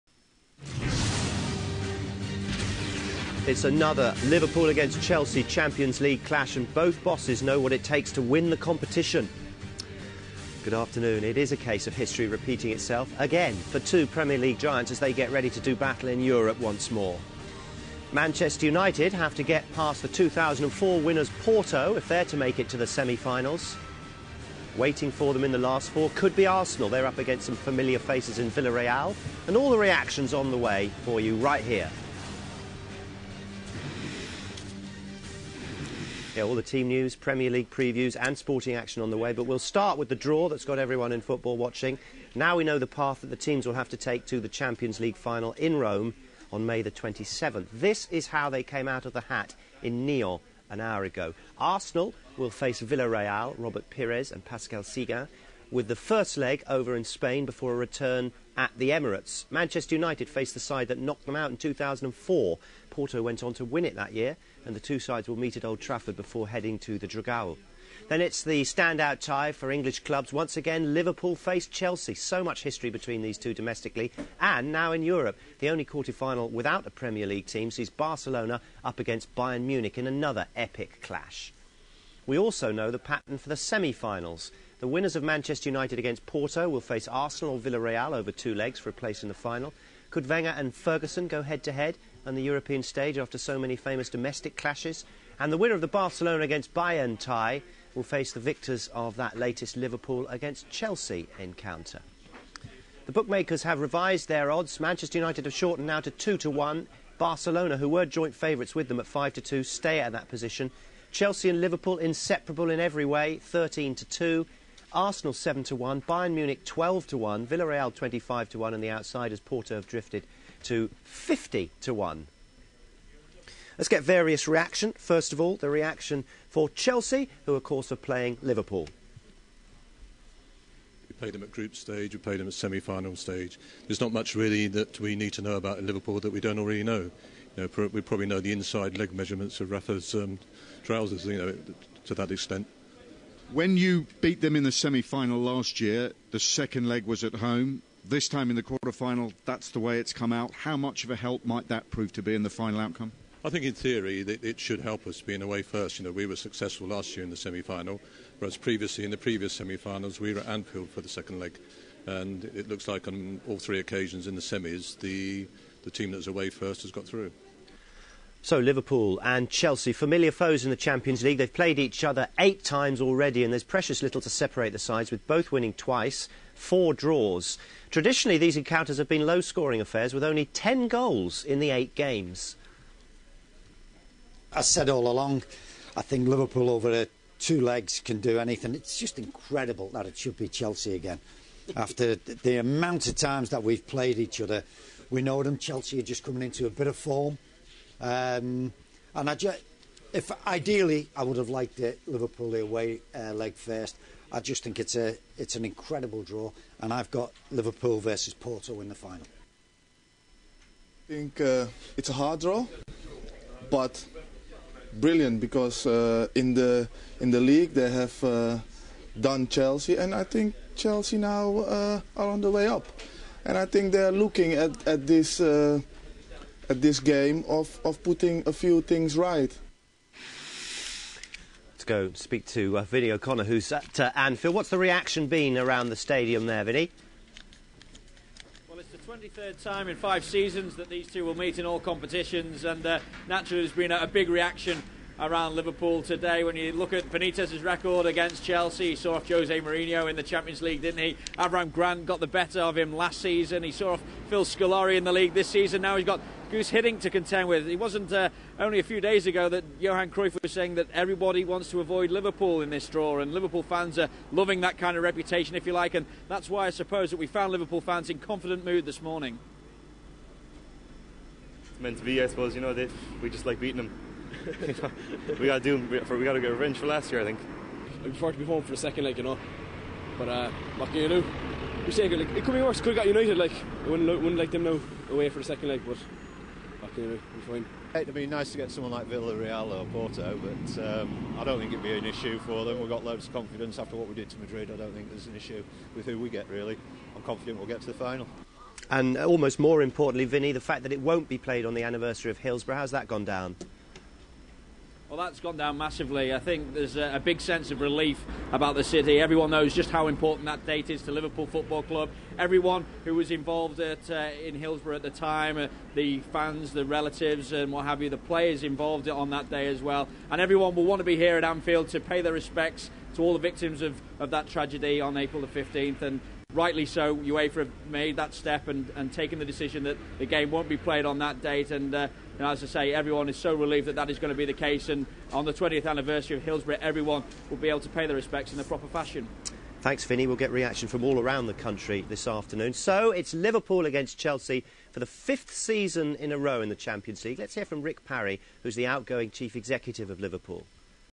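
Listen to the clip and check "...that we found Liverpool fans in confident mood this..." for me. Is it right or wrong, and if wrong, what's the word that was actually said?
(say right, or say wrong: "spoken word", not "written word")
right.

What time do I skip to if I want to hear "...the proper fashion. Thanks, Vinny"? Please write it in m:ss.
5:38.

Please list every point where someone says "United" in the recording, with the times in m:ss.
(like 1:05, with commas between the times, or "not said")
0:18, 0:59, 1:25, 1:45, 4:43.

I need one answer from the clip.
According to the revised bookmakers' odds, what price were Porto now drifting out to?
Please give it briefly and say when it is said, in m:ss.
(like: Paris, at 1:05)
50 to 1, at 2:01.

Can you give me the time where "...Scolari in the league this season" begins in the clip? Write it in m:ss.
4:14.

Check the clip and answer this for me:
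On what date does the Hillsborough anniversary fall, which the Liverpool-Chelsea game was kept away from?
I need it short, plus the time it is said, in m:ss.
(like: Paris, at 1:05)
April 15th, at 5:25.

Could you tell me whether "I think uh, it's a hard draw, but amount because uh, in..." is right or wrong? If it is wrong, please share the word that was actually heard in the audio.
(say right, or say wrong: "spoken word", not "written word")
wrong: "brilliant", not "amount".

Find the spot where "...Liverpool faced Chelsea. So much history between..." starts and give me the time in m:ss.
1:10.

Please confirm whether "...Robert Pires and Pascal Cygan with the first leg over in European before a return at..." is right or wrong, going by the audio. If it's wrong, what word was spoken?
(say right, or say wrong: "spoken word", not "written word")
wrong: "Spain", not "European".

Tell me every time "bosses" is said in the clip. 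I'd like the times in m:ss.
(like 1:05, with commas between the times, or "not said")
0:07.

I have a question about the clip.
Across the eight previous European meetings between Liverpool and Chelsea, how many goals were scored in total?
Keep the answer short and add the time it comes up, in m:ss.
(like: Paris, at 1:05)
10, at 3:00.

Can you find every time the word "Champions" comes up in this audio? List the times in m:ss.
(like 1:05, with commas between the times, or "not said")
0:05, 0:44, 2:50, 4:10, 5:46.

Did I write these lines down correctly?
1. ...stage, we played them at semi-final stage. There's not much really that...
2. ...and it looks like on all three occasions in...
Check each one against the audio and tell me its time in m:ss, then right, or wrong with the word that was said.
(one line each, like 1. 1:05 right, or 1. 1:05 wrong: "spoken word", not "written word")
1. 2:11 right
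2. 2:42 right.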